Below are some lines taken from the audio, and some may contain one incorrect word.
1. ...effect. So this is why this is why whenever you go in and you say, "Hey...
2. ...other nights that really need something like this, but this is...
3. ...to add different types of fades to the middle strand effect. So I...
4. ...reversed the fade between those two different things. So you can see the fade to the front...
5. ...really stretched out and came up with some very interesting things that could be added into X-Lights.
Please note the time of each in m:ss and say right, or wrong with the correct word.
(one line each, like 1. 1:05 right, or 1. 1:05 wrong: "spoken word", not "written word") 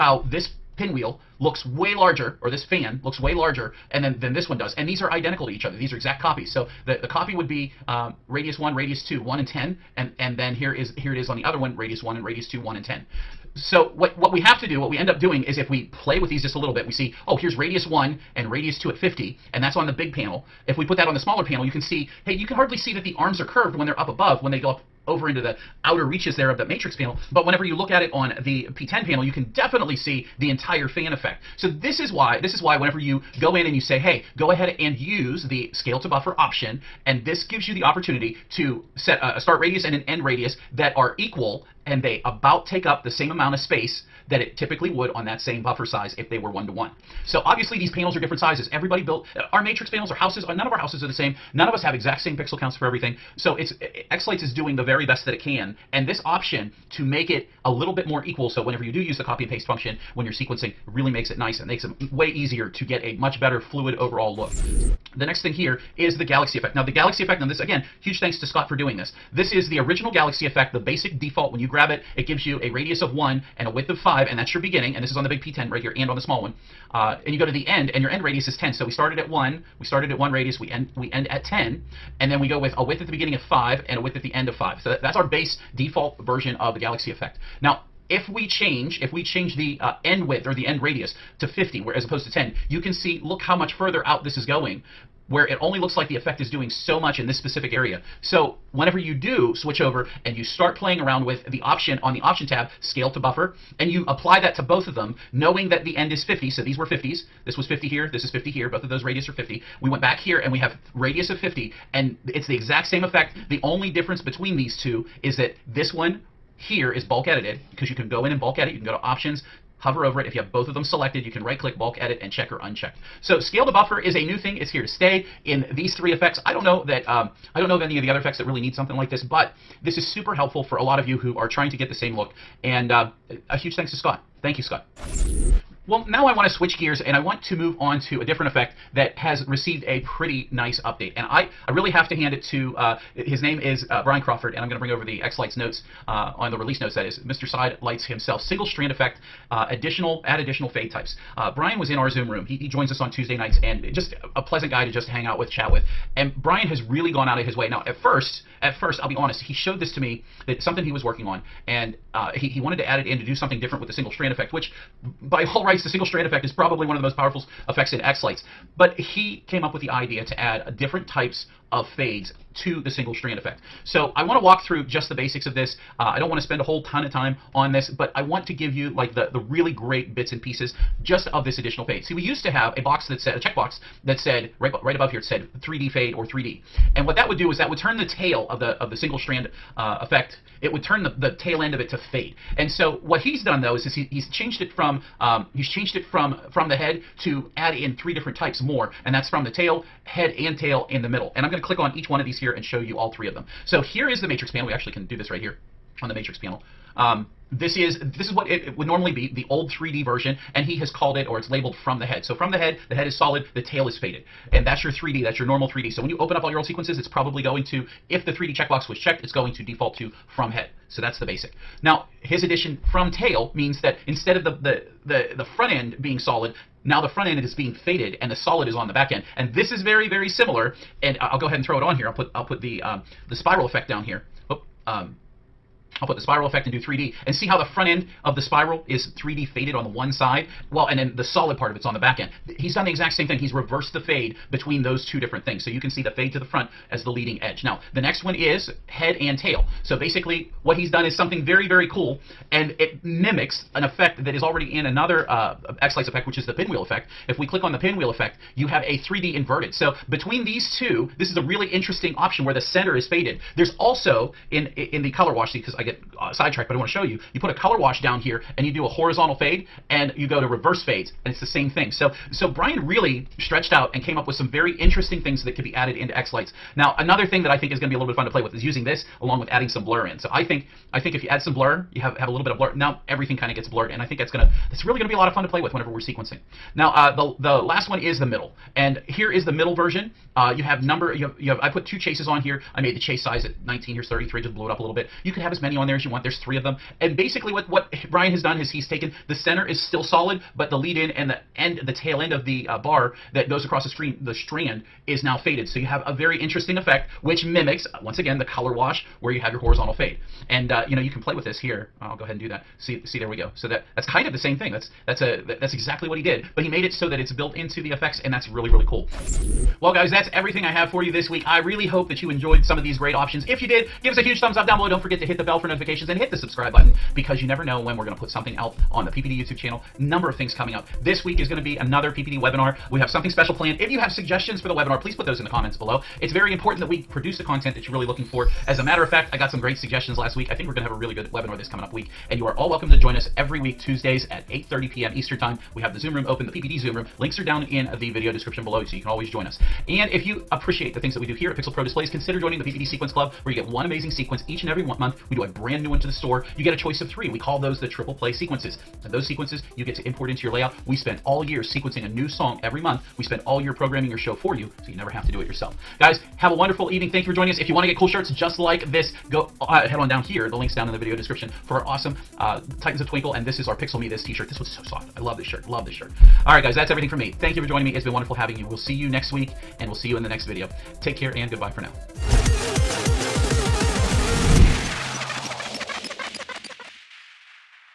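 1. 0:31 right
2. 2:08 wrong: "effects", not "nights"
3. 2:50 wrong: "single", not "middle"
4. 4:03 right
5. 4:32 right.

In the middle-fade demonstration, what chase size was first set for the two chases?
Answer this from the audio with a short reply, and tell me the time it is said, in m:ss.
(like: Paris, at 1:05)
19, at 4:52.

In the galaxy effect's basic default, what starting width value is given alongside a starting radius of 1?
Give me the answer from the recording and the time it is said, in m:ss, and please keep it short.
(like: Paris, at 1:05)
5, at 1:13.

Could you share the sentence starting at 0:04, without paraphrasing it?
And these are identical to each other.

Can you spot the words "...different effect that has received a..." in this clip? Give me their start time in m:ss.
2:18.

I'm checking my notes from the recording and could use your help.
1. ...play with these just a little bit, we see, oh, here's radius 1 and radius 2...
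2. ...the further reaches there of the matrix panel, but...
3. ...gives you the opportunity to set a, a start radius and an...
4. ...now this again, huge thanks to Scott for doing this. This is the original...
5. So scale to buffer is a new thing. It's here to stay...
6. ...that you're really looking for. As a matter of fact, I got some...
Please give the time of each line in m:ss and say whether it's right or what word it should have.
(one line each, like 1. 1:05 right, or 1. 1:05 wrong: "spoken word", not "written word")
1. 0:15 right
2. 0:25 wrong: "outer", not "further"
3. 0:37 right
4. 1:07 right
5. 2:03 right
6. 5:37 right.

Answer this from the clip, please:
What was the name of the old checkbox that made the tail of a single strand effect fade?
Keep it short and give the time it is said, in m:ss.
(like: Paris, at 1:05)
3D, at 3:05.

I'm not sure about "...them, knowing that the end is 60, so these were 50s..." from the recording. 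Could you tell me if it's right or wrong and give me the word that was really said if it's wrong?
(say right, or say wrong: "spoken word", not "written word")
wrong: "50", not "60".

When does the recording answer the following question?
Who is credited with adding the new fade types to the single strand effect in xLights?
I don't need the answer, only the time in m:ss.
2:24.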